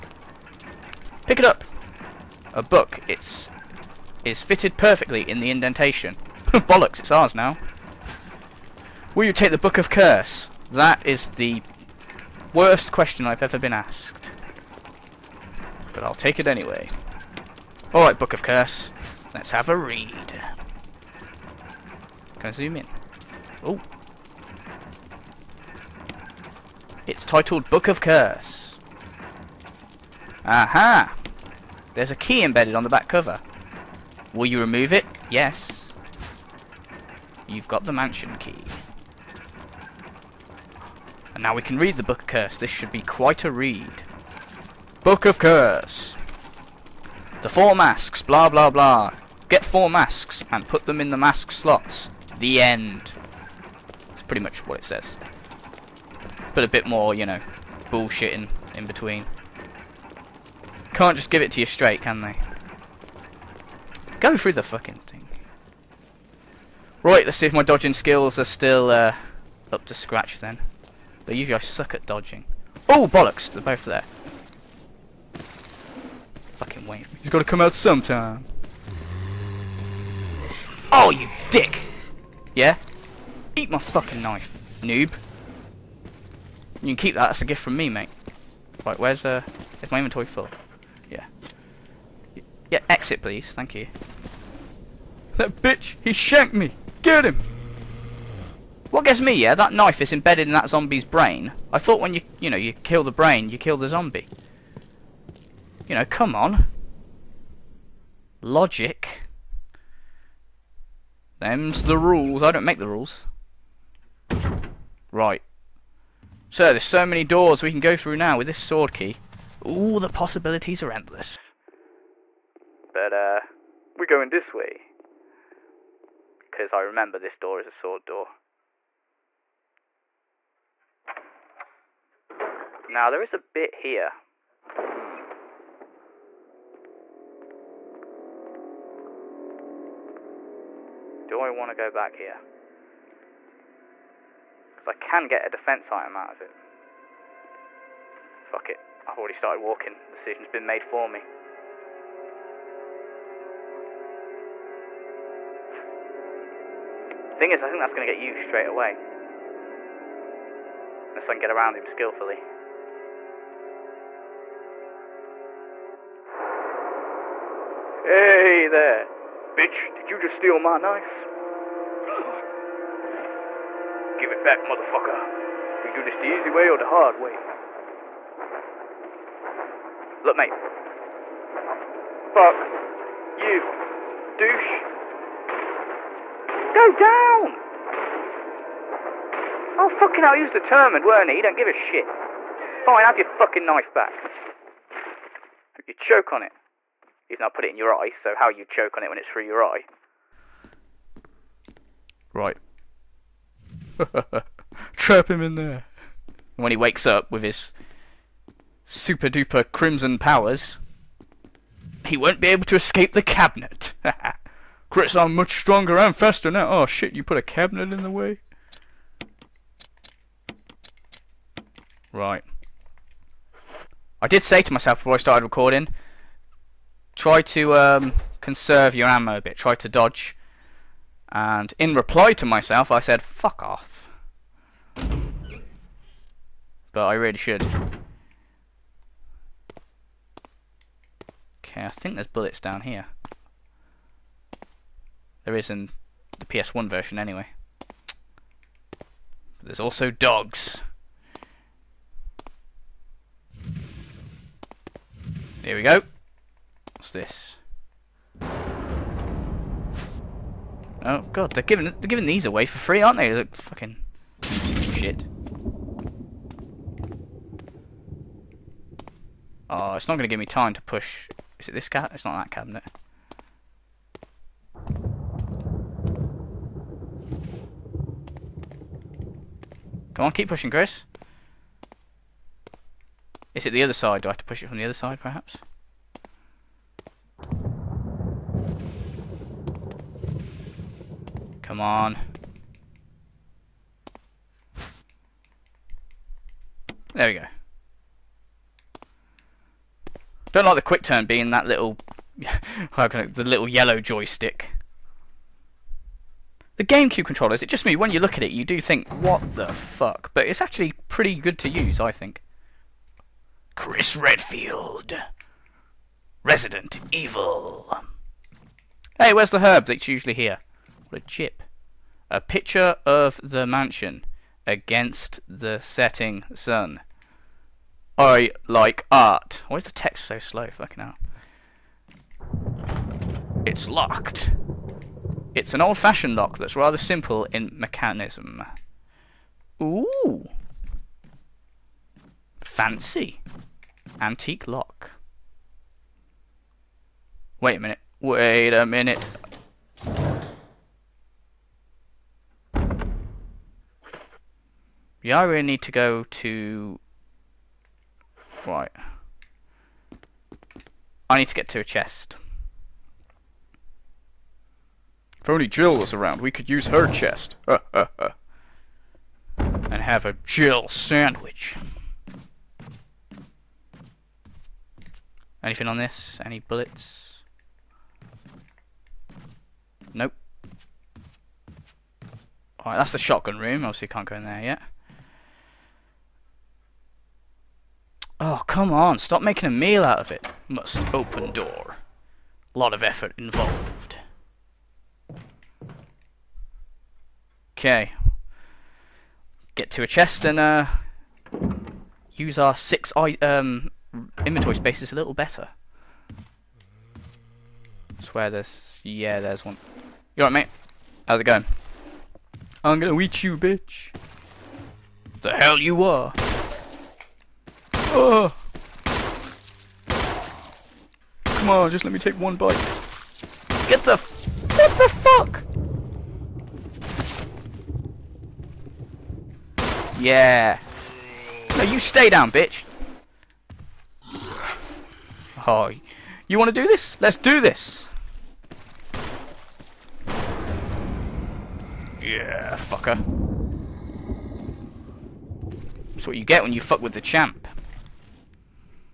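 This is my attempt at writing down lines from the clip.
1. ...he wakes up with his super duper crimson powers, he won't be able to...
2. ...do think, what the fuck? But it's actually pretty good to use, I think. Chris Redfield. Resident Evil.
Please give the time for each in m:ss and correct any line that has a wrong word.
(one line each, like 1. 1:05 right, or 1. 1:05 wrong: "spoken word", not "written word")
1. 3:26 right
2. 5:08 right.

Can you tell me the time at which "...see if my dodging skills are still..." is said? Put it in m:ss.
1:07.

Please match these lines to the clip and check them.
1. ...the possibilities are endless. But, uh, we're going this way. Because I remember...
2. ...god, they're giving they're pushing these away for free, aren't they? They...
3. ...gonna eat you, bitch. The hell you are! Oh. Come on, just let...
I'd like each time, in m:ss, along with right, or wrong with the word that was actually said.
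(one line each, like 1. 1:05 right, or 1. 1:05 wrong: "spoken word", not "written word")
1. 2:00 right
2. 4:21 wrong: "giving", not "pushing"
3. 6:52 right.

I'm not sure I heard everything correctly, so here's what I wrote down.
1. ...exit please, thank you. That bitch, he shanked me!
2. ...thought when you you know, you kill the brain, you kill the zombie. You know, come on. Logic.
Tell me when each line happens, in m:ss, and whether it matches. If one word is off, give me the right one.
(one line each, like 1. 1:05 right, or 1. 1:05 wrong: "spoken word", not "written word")
1. 1:32 right
2. 1:41 right.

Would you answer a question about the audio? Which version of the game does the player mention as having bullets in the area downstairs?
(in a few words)
PS1 version.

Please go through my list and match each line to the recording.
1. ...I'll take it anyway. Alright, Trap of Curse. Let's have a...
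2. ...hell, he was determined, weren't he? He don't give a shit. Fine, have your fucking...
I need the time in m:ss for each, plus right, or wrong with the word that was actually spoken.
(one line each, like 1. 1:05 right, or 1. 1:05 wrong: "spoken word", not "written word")
1. 0:16 wrong: "Book", not "Trap"
2. 3:10 right.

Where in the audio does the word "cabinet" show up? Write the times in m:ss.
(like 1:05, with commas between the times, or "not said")
3:33, 3:37, 4:32.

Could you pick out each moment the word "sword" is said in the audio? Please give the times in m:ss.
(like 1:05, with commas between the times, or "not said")
1:58, 2:07.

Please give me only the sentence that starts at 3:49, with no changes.
Try to dodge and in reply to myself, I said, fuck off.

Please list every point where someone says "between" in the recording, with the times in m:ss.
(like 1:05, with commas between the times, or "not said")
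0:58.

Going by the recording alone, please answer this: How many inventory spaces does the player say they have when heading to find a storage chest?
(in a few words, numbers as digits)
6.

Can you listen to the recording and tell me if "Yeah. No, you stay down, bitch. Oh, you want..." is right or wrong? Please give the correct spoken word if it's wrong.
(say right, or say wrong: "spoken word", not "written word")
right.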